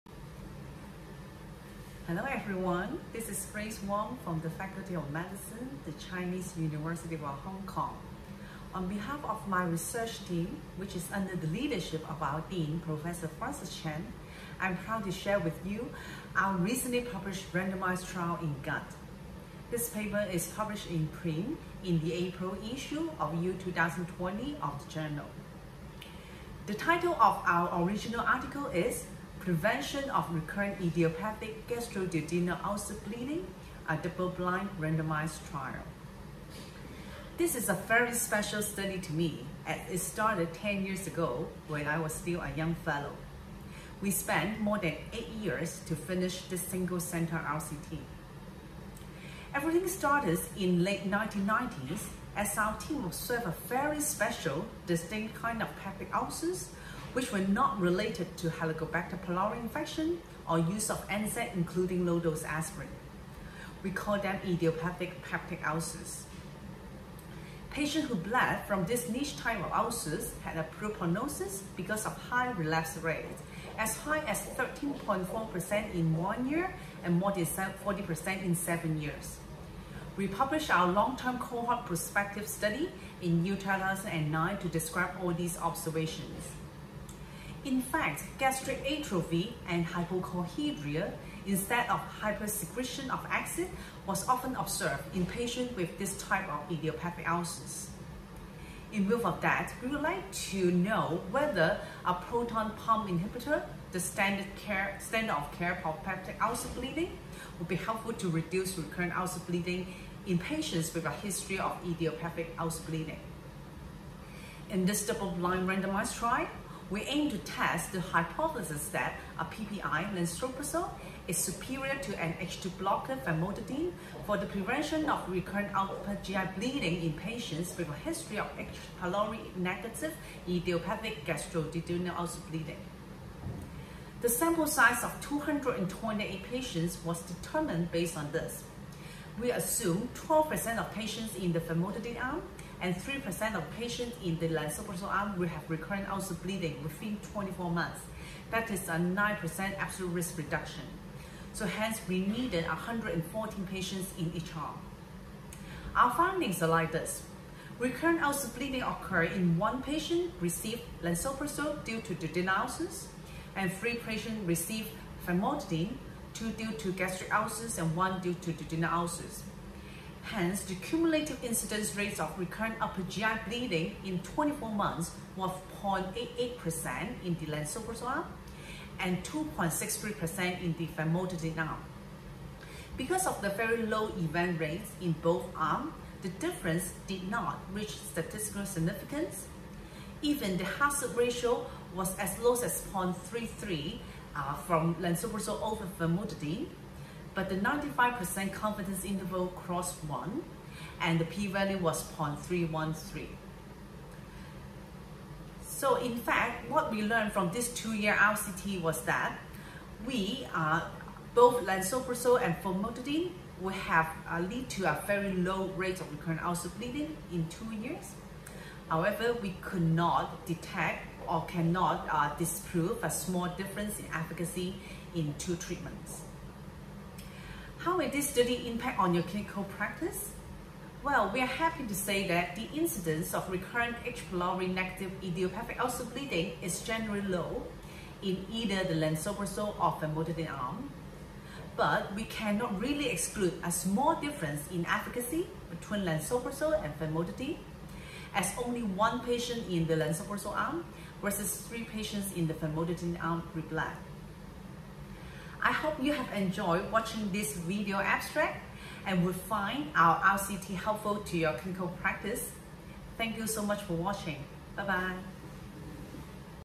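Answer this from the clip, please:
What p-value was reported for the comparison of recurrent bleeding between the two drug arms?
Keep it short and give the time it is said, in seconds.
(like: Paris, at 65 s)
0.313, at 202 s.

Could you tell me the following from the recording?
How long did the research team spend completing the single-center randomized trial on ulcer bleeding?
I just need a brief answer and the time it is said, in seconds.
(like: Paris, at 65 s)
more than 8 years, at 44 s.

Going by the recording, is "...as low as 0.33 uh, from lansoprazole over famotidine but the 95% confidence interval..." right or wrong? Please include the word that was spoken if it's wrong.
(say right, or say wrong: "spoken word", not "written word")
right.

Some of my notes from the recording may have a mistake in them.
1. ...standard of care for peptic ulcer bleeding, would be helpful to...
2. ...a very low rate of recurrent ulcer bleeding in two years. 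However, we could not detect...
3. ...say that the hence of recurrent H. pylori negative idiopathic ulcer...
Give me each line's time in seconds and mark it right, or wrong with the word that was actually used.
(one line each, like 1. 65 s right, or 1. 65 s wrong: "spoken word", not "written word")
1. 104 s right
2. 214 s right
3. 231 s wrong: "incidence", not "hence".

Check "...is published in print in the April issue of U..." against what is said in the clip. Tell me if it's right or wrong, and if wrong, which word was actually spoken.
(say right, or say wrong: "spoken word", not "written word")
right.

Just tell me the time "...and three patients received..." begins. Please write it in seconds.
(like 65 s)
163 s.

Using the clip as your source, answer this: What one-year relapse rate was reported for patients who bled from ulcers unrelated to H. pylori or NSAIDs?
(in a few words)
13.4%.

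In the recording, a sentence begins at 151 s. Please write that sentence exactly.
So hence, we needed 114 patients in each arm.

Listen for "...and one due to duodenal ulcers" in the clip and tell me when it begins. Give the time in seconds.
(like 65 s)
167 s.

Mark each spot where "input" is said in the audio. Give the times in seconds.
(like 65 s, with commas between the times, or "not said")
not said.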